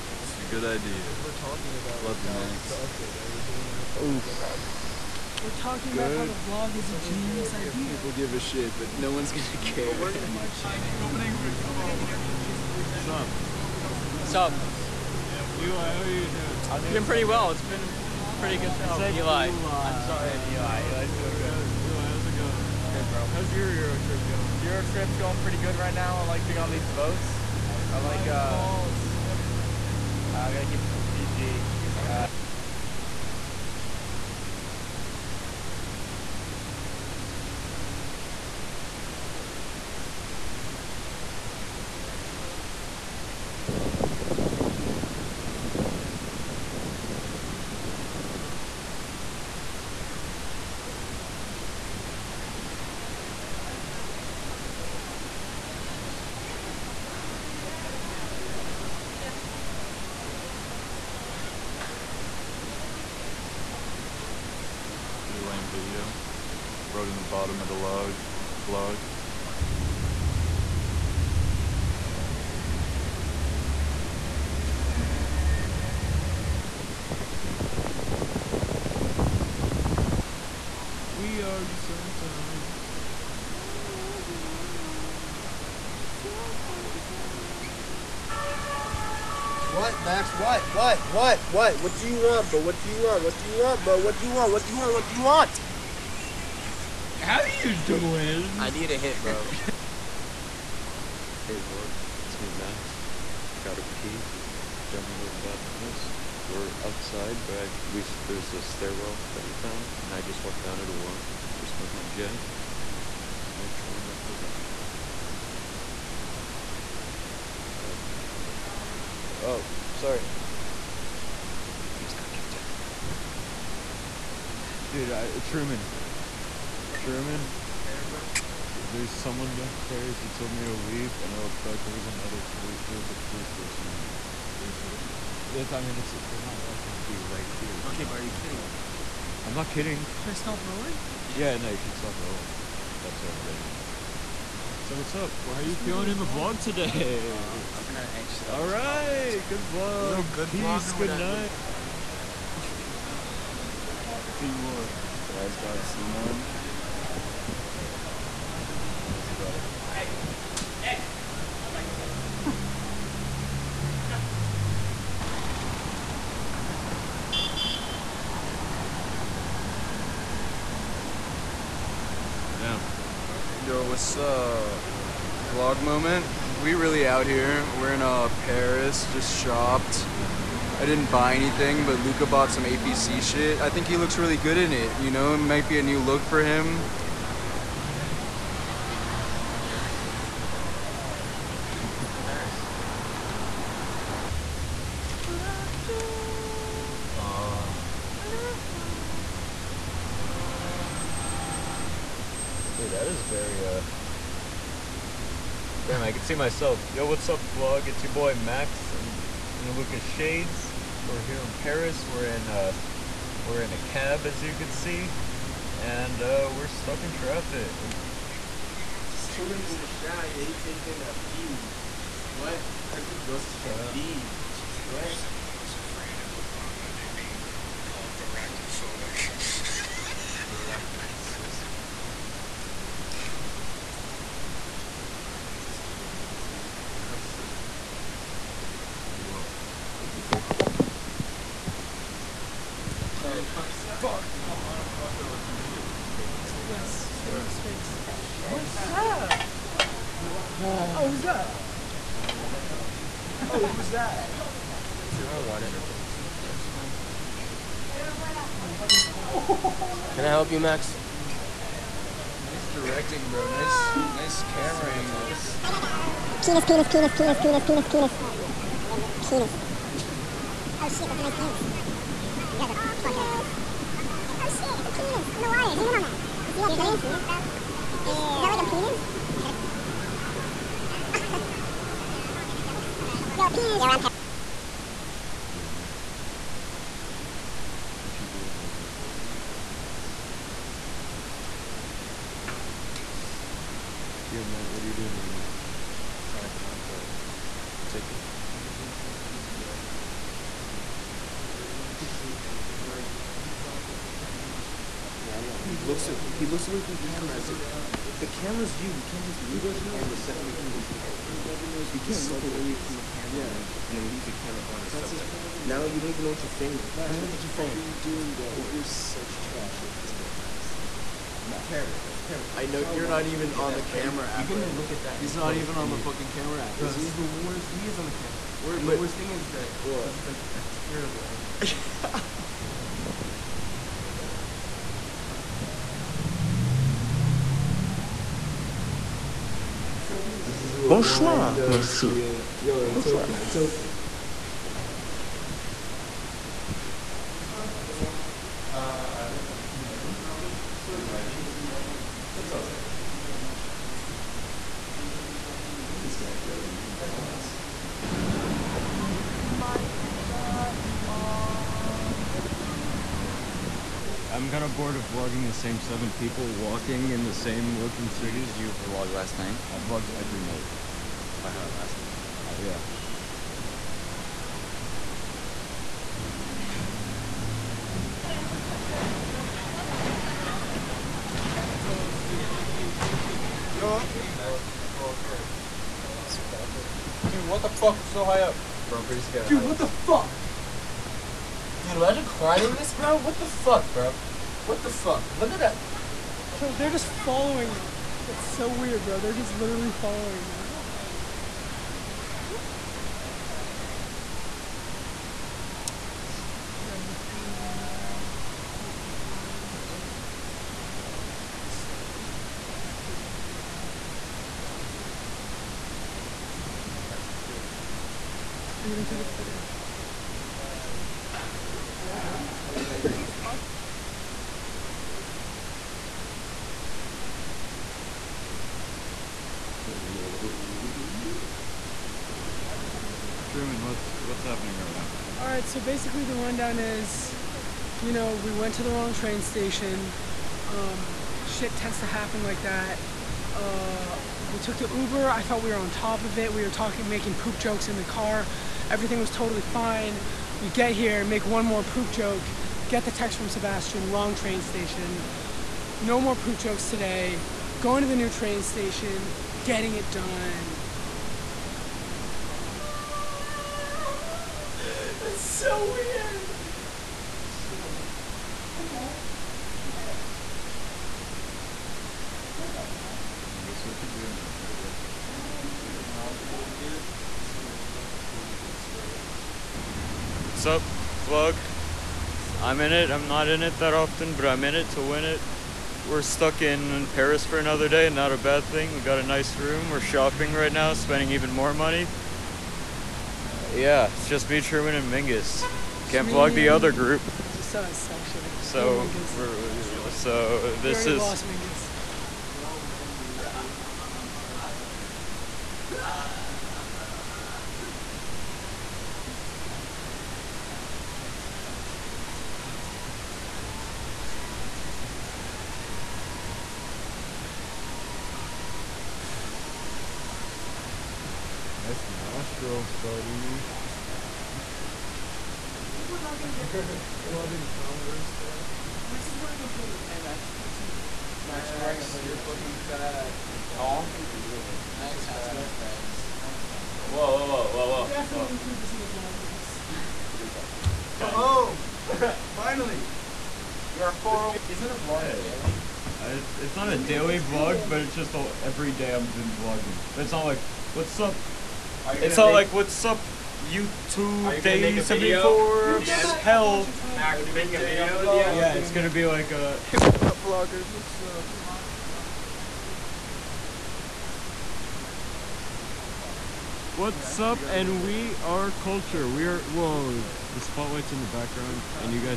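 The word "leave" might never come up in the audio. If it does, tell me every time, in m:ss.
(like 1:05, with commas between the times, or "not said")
2:10, 5:14.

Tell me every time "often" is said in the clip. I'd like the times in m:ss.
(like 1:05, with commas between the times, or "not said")
8:03, 8:53.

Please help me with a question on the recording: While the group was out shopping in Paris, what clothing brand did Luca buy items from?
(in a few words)
APC.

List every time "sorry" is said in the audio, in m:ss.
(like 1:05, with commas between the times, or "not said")
0:20, 1:59.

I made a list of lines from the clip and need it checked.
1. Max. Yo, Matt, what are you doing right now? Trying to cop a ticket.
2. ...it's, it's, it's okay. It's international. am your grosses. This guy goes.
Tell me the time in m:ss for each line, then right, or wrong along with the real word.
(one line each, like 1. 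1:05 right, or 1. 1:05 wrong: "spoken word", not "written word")
1. 4:50 right
2. 5:50 wrong: "images", not "grosses".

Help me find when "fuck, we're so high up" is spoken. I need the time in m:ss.
6:27.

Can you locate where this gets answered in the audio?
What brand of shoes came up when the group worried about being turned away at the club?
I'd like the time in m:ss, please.
8:47.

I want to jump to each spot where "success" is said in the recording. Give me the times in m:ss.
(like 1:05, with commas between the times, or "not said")
not said.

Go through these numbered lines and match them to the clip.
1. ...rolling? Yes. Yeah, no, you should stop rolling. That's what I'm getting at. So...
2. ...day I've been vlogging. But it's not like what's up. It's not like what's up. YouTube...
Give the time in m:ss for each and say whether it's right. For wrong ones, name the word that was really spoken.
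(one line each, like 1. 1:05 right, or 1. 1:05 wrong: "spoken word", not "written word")
1. 2:20 right
2. 9:08 right.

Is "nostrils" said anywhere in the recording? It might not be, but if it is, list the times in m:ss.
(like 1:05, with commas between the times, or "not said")
8:42.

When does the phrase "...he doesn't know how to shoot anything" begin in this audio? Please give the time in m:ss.
5:01.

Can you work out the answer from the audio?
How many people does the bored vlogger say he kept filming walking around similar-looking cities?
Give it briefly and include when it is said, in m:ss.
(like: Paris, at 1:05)
7, at 6:05.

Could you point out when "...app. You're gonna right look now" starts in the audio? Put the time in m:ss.
5:24.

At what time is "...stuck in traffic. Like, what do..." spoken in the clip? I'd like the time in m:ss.
3:36.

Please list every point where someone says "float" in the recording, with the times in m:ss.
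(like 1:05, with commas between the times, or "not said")
not said.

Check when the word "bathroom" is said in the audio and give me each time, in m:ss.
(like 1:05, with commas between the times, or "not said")
1:45, 1:54.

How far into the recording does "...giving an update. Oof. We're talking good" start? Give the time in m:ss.
0:03.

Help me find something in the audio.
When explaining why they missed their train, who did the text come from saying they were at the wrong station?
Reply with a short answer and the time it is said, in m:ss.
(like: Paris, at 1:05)
Sebastian, at 7:33.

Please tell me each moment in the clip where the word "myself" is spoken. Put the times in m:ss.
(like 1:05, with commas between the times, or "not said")
3:26.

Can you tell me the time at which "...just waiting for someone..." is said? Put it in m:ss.
8:23.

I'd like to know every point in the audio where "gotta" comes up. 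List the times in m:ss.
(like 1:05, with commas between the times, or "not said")
0:30, 1:43, 6:46.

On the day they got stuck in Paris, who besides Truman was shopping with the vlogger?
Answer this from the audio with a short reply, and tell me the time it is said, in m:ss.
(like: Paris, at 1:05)
Mingus, at 8:15.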